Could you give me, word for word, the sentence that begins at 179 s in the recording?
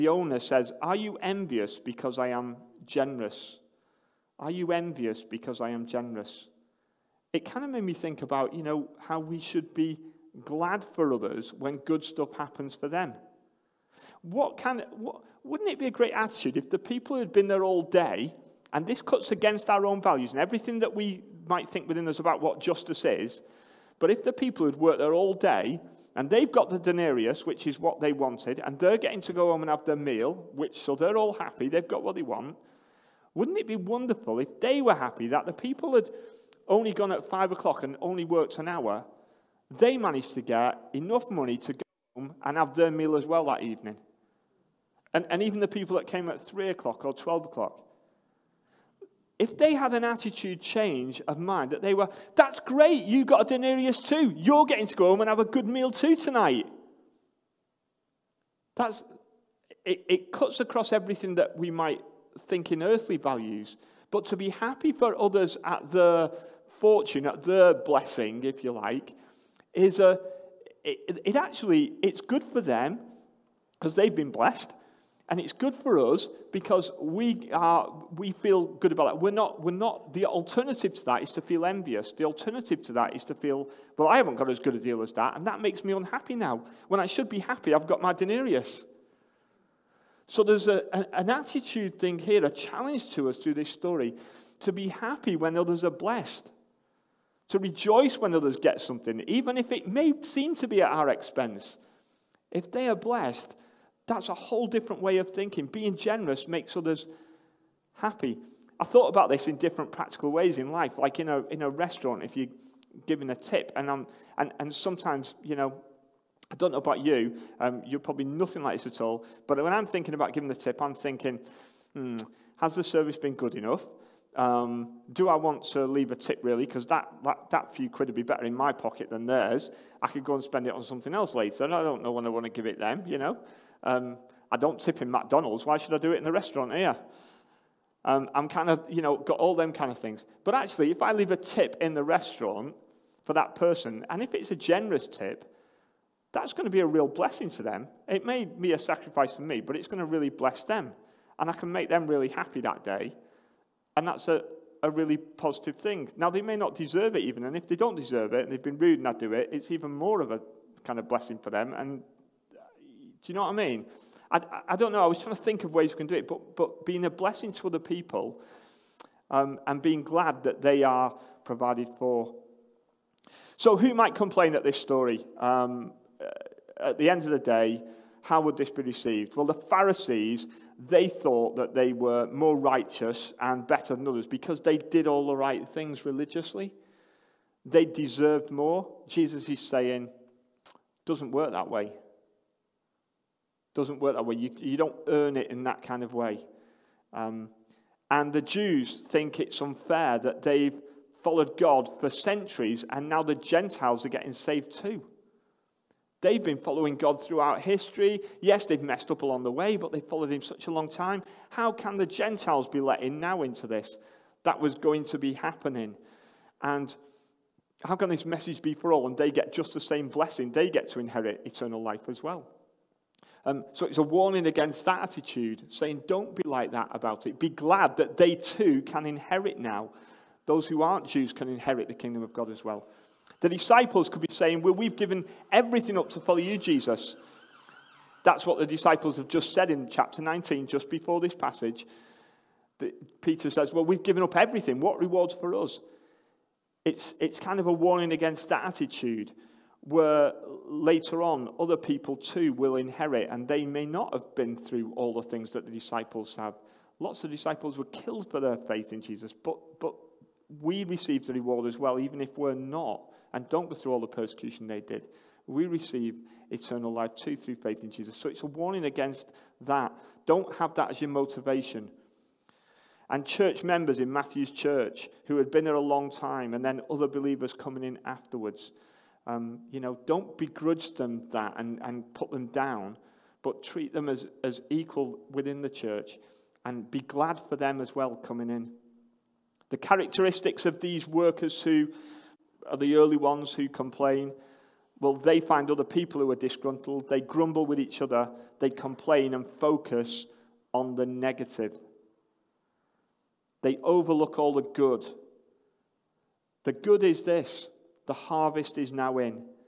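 Well, the Pharisees, they thought that they were more righteous and better than others because they did all the right things religiously.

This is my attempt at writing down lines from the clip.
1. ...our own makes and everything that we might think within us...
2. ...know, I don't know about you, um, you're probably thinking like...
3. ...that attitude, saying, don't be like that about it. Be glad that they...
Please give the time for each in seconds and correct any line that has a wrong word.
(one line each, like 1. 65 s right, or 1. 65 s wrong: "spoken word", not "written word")
1. 19 s wrong: "values", not "makes"
2. 115 s wrong: "nothing", not "thinking"
3. 224 s right.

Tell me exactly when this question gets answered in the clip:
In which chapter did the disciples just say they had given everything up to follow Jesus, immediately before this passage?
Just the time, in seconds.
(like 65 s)
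239 s.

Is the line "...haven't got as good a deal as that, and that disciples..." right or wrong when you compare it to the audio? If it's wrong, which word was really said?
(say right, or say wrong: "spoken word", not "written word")
wrong: "makes", not "disciples".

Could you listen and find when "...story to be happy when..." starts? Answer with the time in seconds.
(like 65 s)
93 s.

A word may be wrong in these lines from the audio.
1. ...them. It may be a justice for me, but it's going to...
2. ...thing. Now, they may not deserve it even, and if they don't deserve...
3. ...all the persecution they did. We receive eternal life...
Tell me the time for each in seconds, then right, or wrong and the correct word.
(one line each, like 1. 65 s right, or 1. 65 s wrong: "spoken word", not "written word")
1. 147 s wrong: "sacrifice", not "justice"
2. 155 s right
3. 263 s right.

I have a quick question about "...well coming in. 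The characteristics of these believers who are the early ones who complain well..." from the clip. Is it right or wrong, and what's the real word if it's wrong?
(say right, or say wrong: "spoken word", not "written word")
wrong: "workers", not "believers".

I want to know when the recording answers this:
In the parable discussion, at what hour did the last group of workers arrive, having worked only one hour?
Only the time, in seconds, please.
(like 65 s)
37 s.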